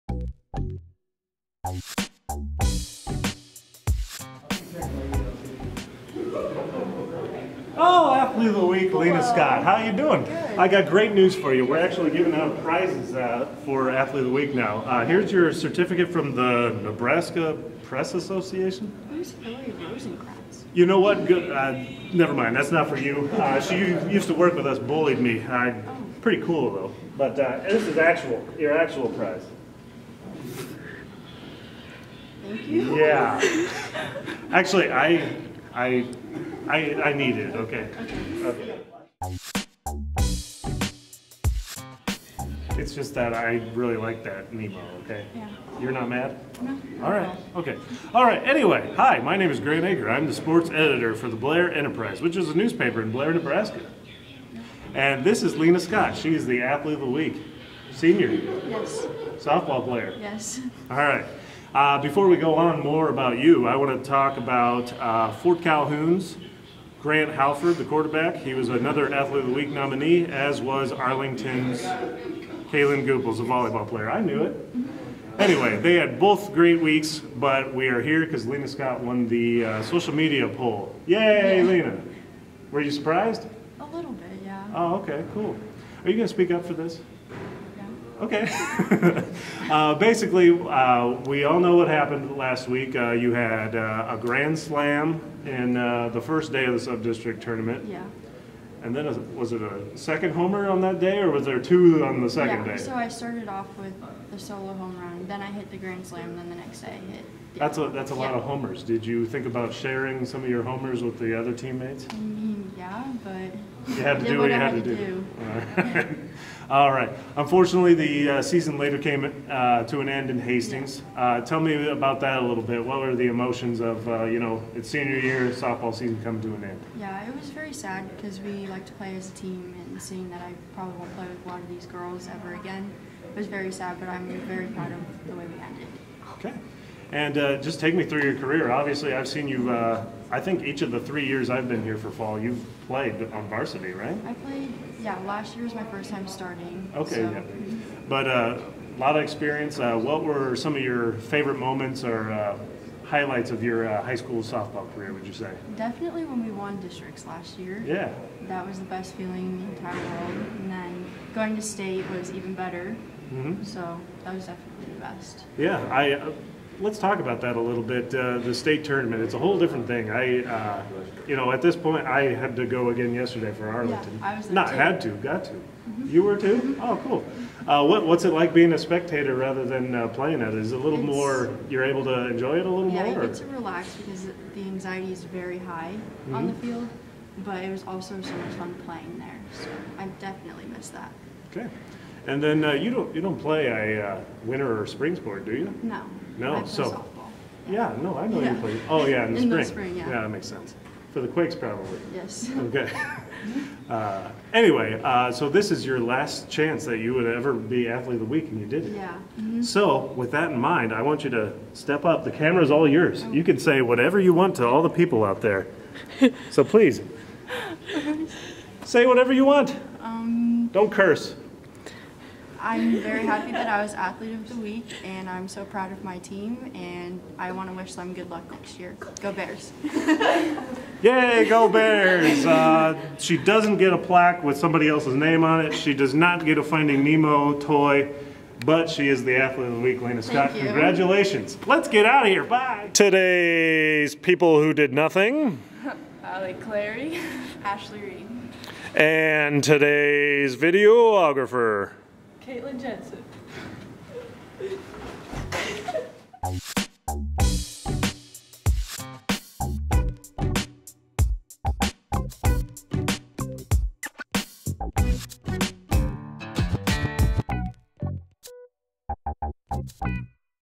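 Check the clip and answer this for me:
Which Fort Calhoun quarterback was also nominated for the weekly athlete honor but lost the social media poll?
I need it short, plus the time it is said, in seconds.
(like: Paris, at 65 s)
Grant Halford, at 67 s.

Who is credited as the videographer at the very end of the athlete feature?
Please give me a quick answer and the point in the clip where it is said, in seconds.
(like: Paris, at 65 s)
Caitlin Jensen, at 252 s.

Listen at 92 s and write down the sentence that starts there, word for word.
Uh, you had uh, a grand slam in uh, the first day of the sub-district tournament.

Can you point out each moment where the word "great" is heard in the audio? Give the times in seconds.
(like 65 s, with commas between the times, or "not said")
10 s, 76 s.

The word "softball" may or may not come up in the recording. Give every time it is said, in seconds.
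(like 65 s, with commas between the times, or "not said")
59 s, 125 s, 154 s, 196 s.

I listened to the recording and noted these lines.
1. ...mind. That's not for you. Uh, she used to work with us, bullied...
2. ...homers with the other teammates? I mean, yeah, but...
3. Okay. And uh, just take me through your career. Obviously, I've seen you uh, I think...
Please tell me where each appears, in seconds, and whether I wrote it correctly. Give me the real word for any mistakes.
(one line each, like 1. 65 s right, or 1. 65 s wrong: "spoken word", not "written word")
1. 22 s right
2. 110 s right
3. 136 s right.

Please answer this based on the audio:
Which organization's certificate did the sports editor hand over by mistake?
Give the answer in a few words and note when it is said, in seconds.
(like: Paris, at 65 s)
Nebraska Press Association, at 16 s.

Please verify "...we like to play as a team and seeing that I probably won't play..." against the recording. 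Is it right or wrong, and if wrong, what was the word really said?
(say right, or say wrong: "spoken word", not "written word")
right.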